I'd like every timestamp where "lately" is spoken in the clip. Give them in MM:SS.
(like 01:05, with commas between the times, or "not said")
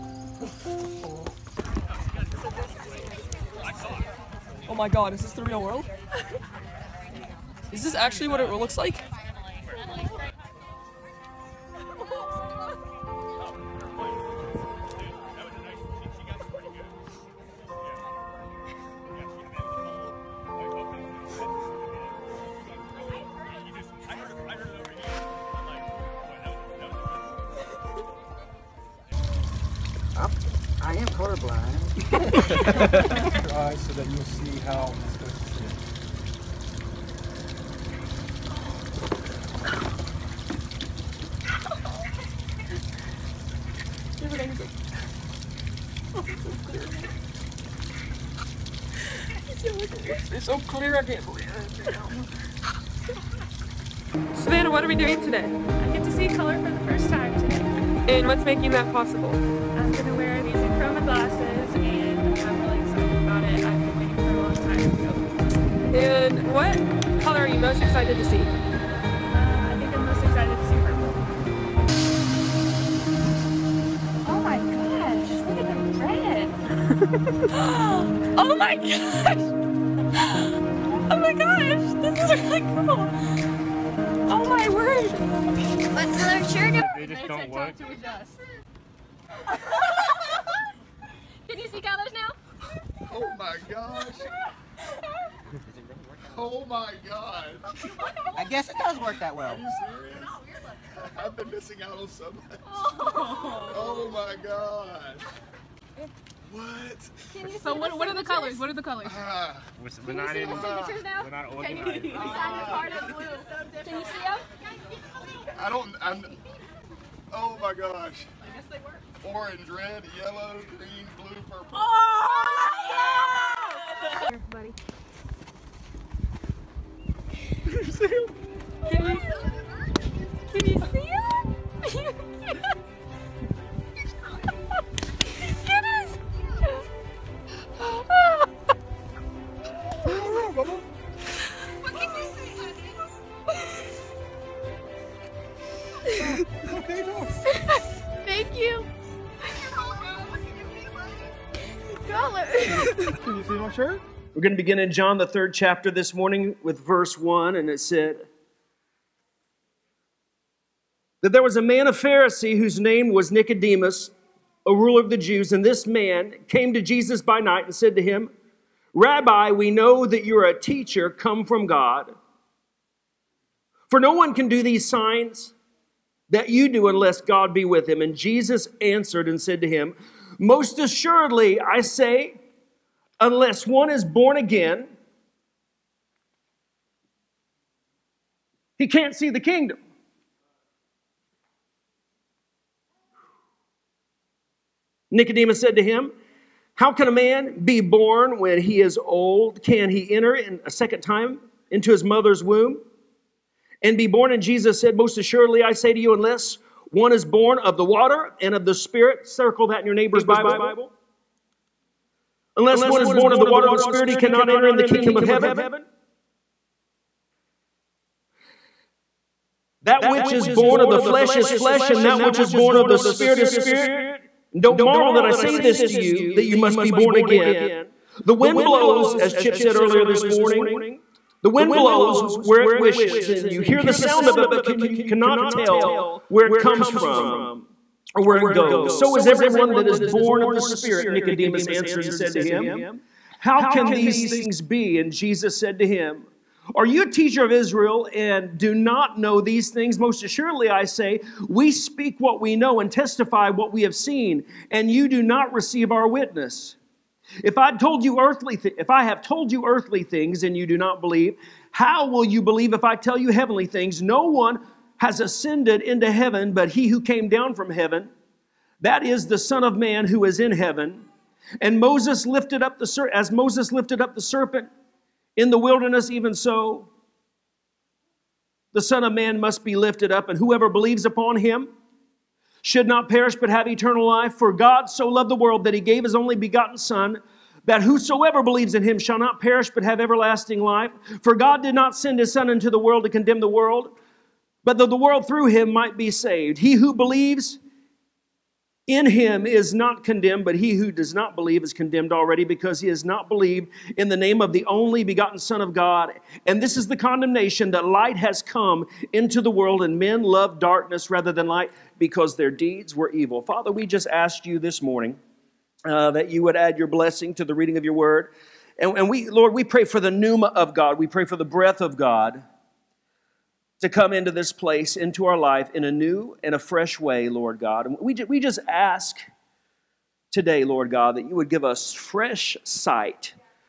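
not said.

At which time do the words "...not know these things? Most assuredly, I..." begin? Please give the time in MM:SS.
04:08.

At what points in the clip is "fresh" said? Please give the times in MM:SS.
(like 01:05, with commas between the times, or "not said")
05:26, 05:31.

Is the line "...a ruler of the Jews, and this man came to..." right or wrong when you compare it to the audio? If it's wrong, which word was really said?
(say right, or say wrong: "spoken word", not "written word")
right.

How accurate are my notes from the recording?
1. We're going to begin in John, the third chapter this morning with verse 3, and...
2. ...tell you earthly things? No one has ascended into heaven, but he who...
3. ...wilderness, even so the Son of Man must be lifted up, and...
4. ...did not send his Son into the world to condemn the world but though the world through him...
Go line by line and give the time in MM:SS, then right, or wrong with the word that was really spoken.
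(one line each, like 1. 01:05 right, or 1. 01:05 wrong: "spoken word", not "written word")
1. 02:34 wrong: "1", not "3"
2. 04:22 wrong: "heavenly", not "earthly"
3. 04:35 right
4. 04:51 right.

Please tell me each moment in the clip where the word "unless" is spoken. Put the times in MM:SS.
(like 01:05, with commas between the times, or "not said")
02:56, 03:03, 03:26, 03:32.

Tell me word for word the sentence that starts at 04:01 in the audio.
Nicodemus answered and said to him, How can these things be?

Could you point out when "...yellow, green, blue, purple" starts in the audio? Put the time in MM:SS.
02:00.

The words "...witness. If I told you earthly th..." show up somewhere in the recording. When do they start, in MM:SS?
04:16.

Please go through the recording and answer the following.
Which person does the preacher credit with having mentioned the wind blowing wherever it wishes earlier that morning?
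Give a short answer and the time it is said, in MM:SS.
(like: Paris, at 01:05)
Chip, at 03:49.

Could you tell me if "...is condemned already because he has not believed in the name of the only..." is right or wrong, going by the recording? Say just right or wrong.
right.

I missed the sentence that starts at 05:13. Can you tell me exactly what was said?
Father, we just asked you this morning uh, that you would add your blessing to the reading of your word.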